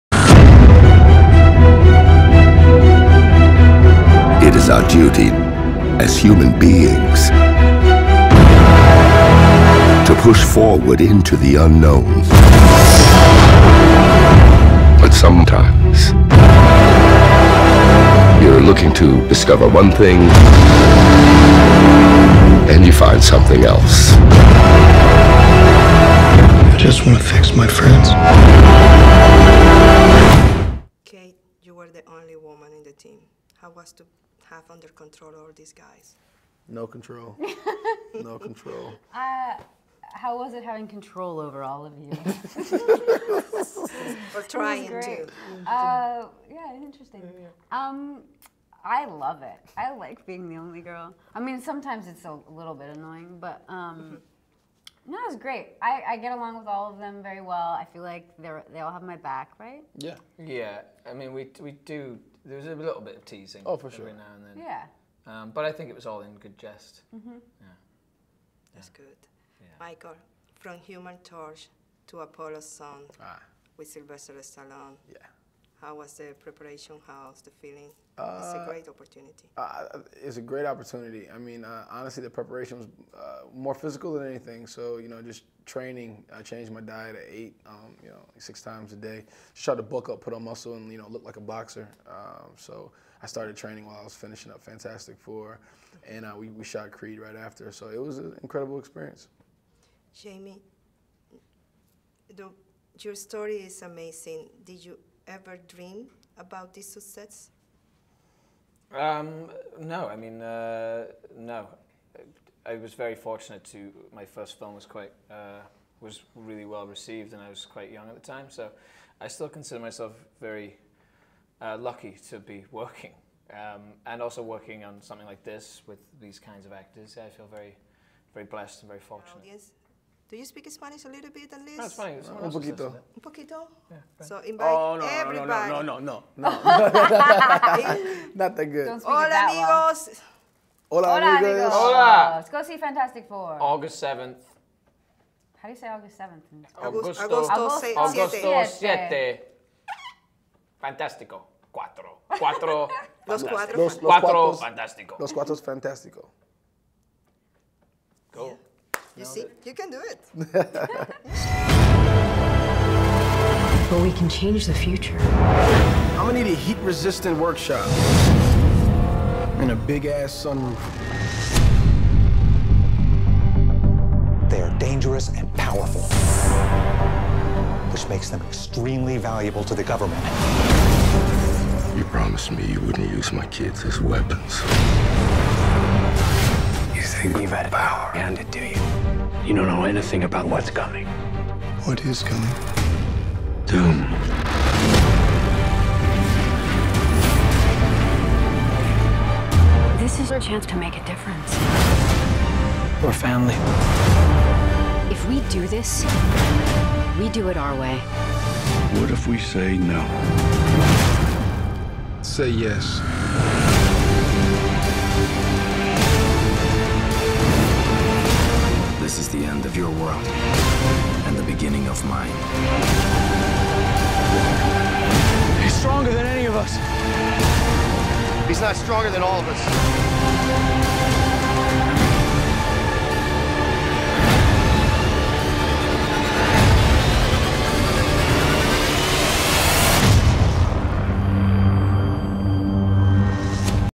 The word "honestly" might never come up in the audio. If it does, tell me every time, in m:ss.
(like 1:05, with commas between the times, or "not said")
1:21.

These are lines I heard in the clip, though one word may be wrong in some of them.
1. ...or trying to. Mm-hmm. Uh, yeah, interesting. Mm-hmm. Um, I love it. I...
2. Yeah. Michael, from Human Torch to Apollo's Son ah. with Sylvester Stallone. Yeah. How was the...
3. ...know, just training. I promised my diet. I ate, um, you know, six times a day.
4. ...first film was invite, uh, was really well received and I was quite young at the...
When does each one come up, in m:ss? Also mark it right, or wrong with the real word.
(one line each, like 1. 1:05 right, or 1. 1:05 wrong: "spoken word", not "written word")
1. 0:44 right
2. 1:09 right
3. 1:25 wrong: "changed", not "promised"
4. 1:54 wrong: "quite", not "invite".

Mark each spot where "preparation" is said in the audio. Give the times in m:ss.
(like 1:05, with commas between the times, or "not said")
1:16, 1:22.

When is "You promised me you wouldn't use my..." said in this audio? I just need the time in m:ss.
3:01.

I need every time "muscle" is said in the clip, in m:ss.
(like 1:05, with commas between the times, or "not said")
1:30.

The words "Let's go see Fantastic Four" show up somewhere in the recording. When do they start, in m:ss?
2:22.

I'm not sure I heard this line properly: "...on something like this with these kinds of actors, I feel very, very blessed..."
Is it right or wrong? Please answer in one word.
right.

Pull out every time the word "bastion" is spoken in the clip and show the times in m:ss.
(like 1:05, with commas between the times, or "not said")
not said.